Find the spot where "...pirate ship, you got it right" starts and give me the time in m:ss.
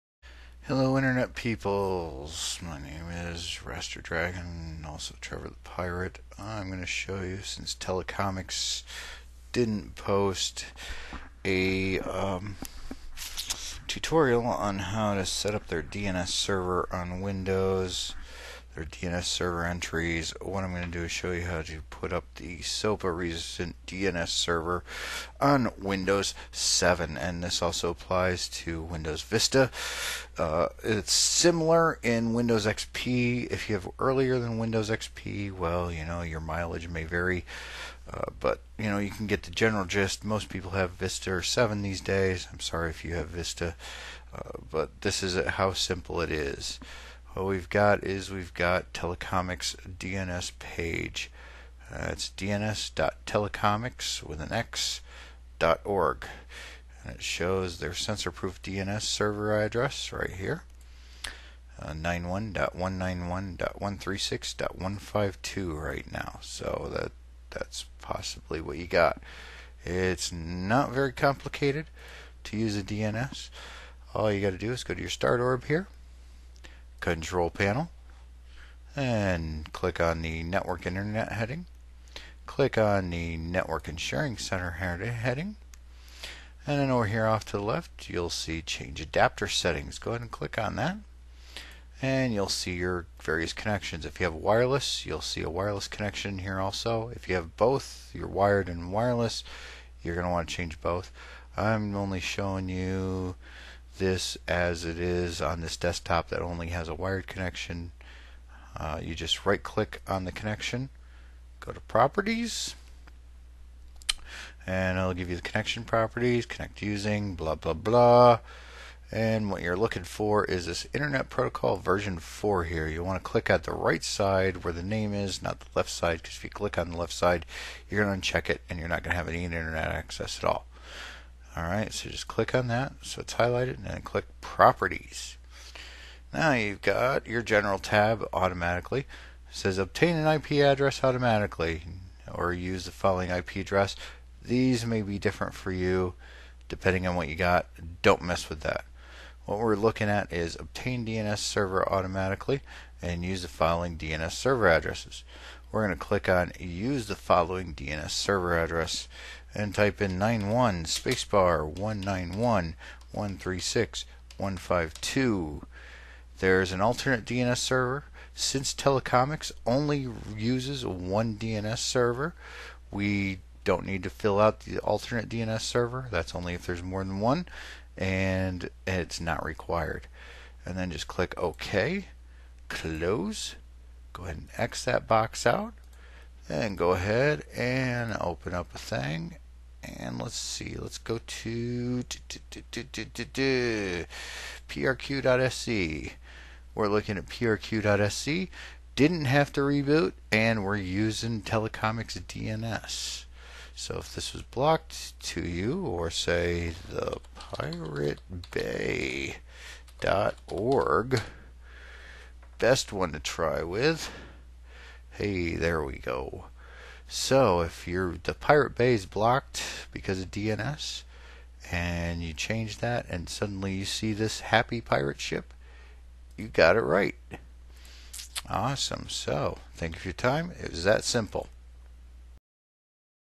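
3:44.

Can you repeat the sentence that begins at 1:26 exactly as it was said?
And then over here off to the left, you'll see Change Adapter Settings.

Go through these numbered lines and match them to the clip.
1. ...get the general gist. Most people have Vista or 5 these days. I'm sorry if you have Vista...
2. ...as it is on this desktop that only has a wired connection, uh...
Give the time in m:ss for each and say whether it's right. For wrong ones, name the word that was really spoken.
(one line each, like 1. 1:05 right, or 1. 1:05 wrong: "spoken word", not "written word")
1. 0:39 wrong: "7", not "5"
2. 1:44 right.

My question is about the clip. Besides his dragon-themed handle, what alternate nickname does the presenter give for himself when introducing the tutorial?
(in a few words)
Trevor the Pirate.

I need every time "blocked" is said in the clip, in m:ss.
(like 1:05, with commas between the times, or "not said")
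3:24, 3:39.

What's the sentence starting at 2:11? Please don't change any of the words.
Alright, so just click on that so it's highlighted and then click Properties.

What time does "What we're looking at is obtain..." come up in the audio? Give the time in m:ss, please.
2:29.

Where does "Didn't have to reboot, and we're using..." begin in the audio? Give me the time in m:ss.
3:18.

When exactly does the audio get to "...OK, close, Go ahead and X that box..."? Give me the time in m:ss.
3:01.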